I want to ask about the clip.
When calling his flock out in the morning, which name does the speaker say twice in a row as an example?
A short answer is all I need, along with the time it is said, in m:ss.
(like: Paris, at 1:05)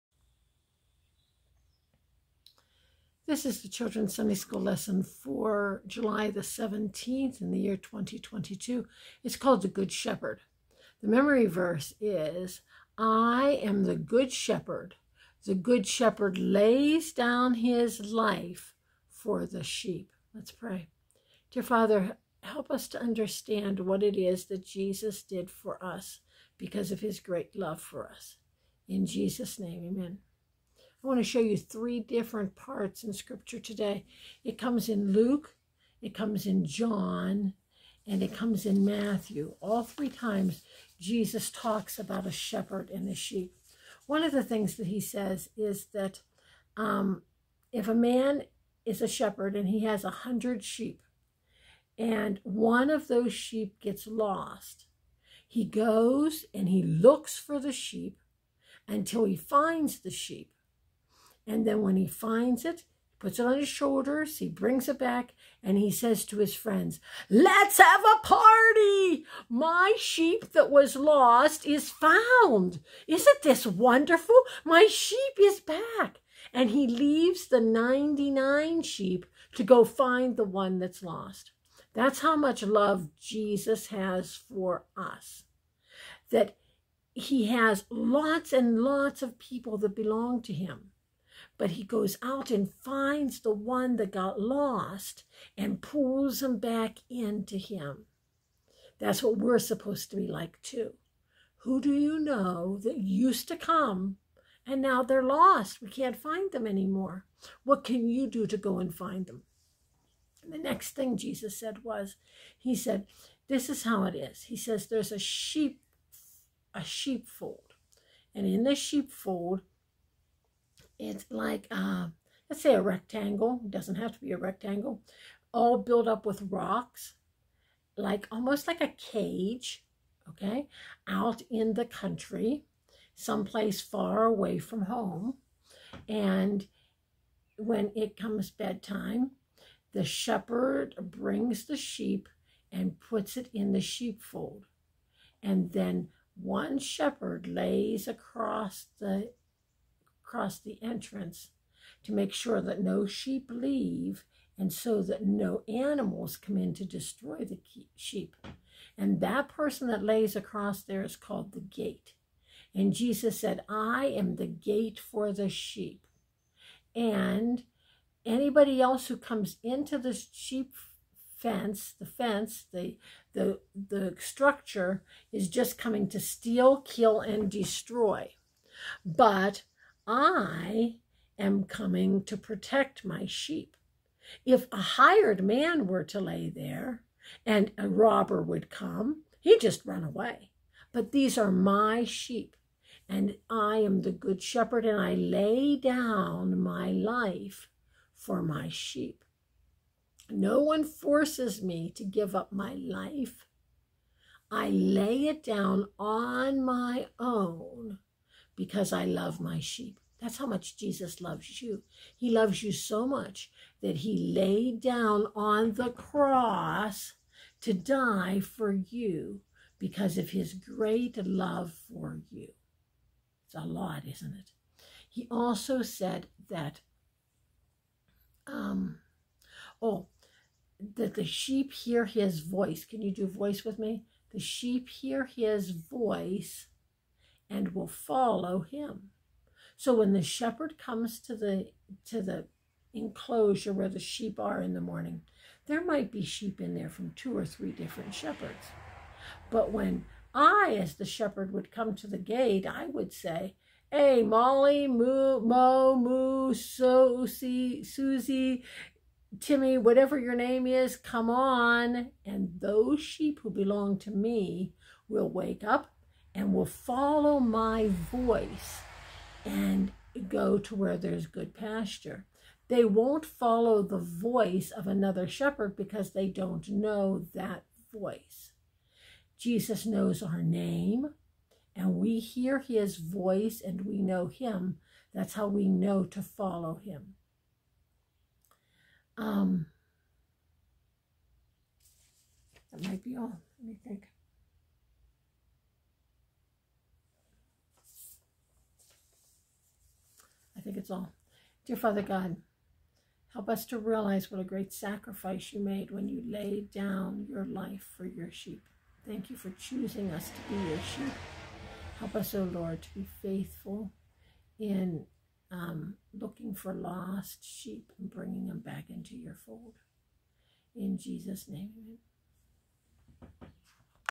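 Susie, at 4:16.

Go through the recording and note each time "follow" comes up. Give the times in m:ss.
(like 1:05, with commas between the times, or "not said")
3:57, 4:26, 4:33, 4:46.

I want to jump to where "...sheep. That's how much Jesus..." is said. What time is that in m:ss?
3:29.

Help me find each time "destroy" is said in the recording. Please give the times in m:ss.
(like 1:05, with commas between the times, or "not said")
2:36, 2:57.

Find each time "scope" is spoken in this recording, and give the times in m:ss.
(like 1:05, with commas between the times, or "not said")
not said.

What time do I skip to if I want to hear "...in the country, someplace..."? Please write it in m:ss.
2:11.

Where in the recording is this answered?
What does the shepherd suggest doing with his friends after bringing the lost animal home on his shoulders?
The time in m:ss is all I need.
1:07.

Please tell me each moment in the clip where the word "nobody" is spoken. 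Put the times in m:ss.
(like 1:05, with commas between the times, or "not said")
not said.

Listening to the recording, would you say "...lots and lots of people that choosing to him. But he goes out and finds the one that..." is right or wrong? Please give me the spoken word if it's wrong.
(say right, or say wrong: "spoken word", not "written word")
wrong: "belong", not "choosing".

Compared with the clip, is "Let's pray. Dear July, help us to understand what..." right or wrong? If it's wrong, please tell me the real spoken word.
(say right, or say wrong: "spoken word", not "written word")
wrong: "Father", not "July".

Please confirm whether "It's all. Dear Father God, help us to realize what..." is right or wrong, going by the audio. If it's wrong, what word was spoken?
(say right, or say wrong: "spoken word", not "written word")
right.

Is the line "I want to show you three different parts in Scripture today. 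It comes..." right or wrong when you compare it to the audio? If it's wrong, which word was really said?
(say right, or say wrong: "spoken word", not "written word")
right.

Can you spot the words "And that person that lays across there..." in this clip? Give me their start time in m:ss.
2:38.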